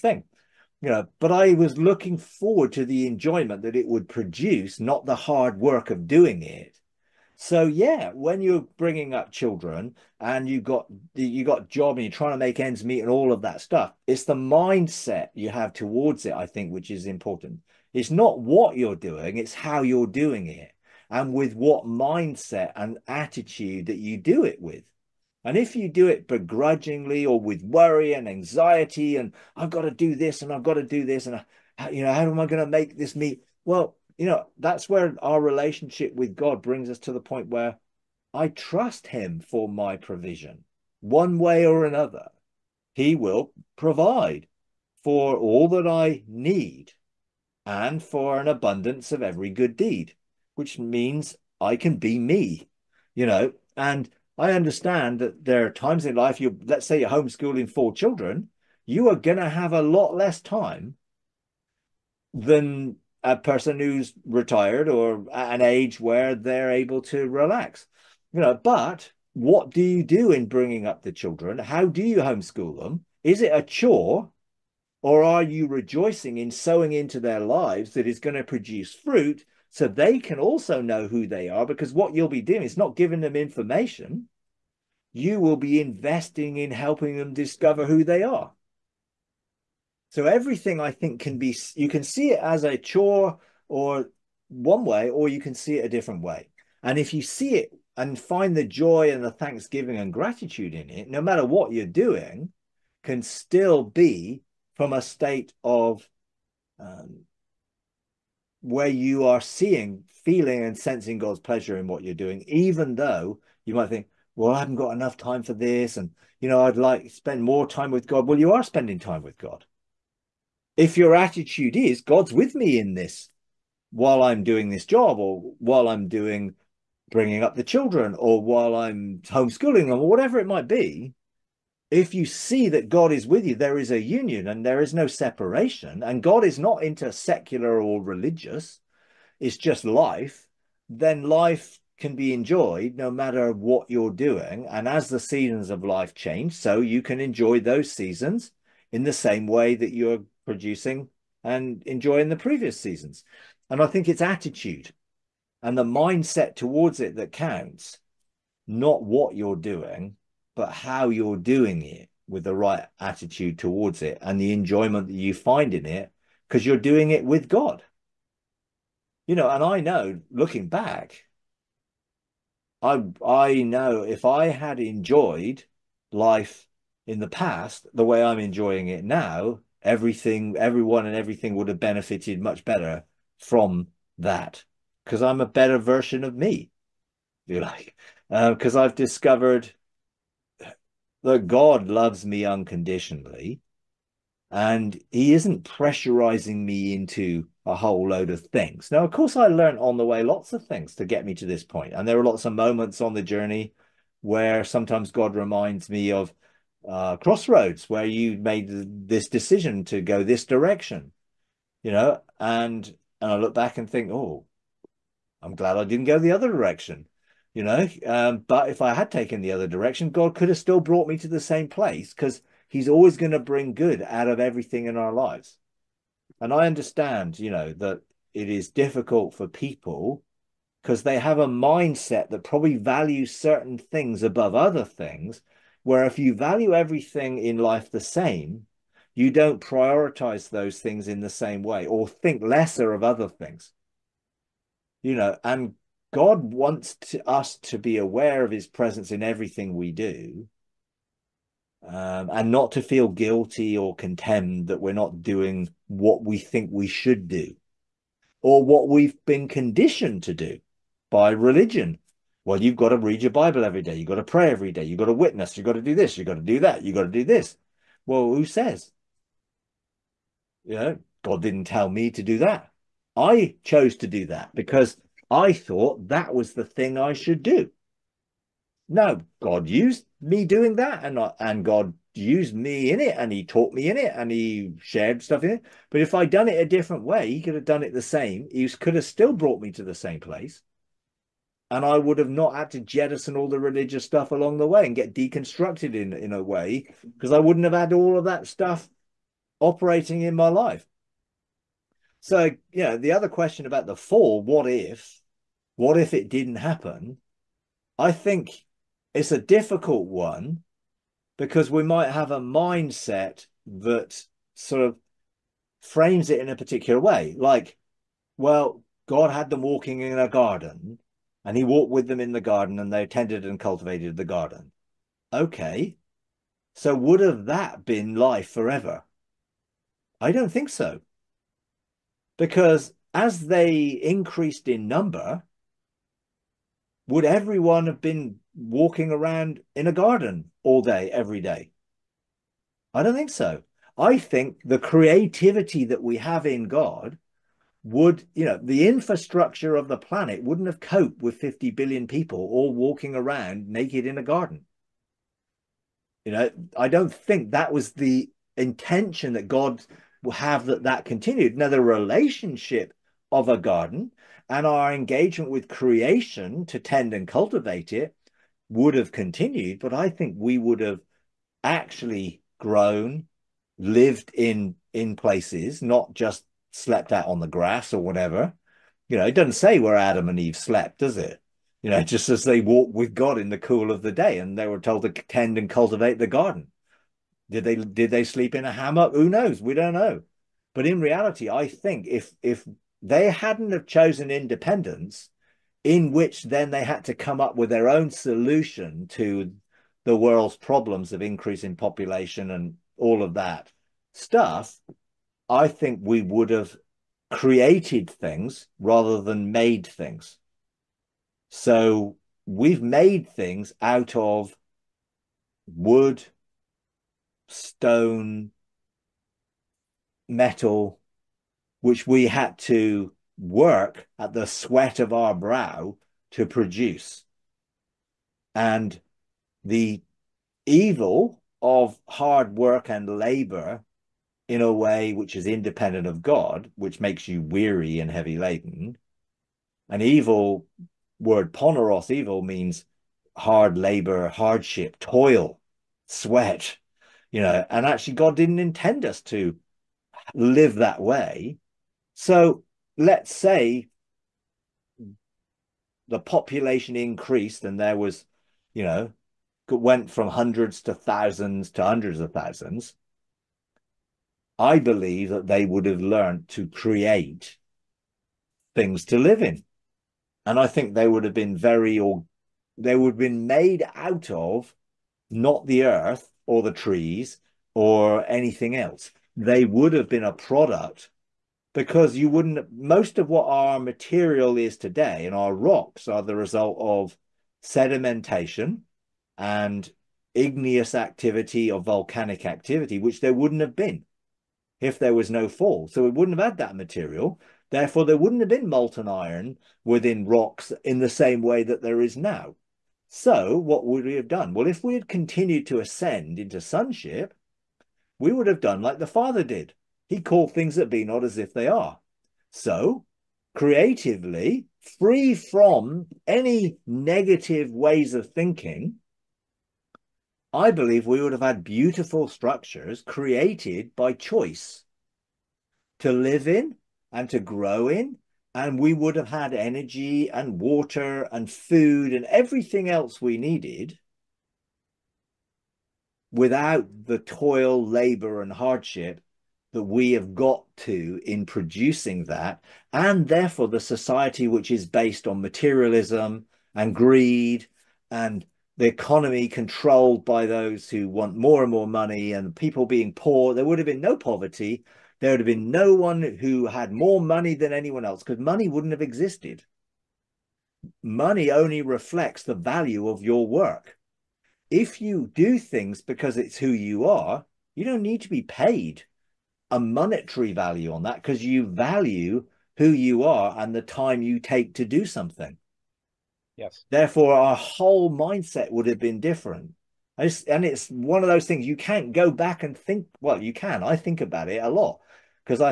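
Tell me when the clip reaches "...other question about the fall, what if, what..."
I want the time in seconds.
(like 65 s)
303 s.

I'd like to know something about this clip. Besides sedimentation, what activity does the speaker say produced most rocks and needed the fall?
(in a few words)
Igneous activity.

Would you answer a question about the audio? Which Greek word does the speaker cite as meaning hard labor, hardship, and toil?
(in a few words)
Poneros.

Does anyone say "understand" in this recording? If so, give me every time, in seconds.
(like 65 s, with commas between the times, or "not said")
54 s, 226 s.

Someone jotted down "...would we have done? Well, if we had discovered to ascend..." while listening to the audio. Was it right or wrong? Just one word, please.
wrong.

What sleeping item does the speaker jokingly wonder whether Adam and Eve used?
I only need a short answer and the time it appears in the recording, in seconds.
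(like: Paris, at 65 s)
A hammock, at 388 s.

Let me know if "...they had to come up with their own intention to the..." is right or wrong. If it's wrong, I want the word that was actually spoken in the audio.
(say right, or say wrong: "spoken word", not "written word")
wrong: "solution", not "intention".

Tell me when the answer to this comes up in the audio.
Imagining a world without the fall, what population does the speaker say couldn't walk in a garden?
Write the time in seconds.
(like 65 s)
351 s.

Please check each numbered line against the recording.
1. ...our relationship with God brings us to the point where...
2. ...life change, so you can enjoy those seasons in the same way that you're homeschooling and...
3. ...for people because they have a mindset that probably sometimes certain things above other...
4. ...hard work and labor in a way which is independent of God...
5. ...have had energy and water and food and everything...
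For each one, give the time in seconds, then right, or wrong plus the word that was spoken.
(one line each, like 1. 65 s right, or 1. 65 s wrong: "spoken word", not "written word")
1. 35 s right
2. 145 s wrong: "producing", not "homeschooling"
3. 229 s wrong: "values", not "sometimes"
4. 432 s right
5. 529 s right.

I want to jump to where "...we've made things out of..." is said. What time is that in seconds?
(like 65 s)
412 s.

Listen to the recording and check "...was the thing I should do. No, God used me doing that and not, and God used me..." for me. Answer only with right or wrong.
right.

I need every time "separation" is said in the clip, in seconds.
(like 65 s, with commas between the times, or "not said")
135 s.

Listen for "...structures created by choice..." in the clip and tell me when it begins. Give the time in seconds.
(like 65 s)
522 s.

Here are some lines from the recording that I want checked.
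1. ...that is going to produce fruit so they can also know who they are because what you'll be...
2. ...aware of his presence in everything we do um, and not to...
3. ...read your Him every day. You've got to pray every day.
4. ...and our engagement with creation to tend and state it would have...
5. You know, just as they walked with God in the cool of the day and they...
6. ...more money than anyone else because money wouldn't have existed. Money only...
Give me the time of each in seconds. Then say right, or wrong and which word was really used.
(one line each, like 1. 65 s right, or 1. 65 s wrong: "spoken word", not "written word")
1. 77 s right
2. 247 s right
3. 262 s wrong: "Bible", not "Him"
4. 364 s wrong: "cultivate", not "state"
5. 381 s right
6. 556 s right.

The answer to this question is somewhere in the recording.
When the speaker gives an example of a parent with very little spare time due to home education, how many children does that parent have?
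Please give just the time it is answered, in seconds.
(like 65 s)
57 s.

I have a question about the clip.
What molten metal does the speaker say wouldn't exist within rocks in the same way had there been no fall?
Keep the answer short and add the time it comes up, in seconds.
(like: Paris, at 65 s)
Iron, at 499 s.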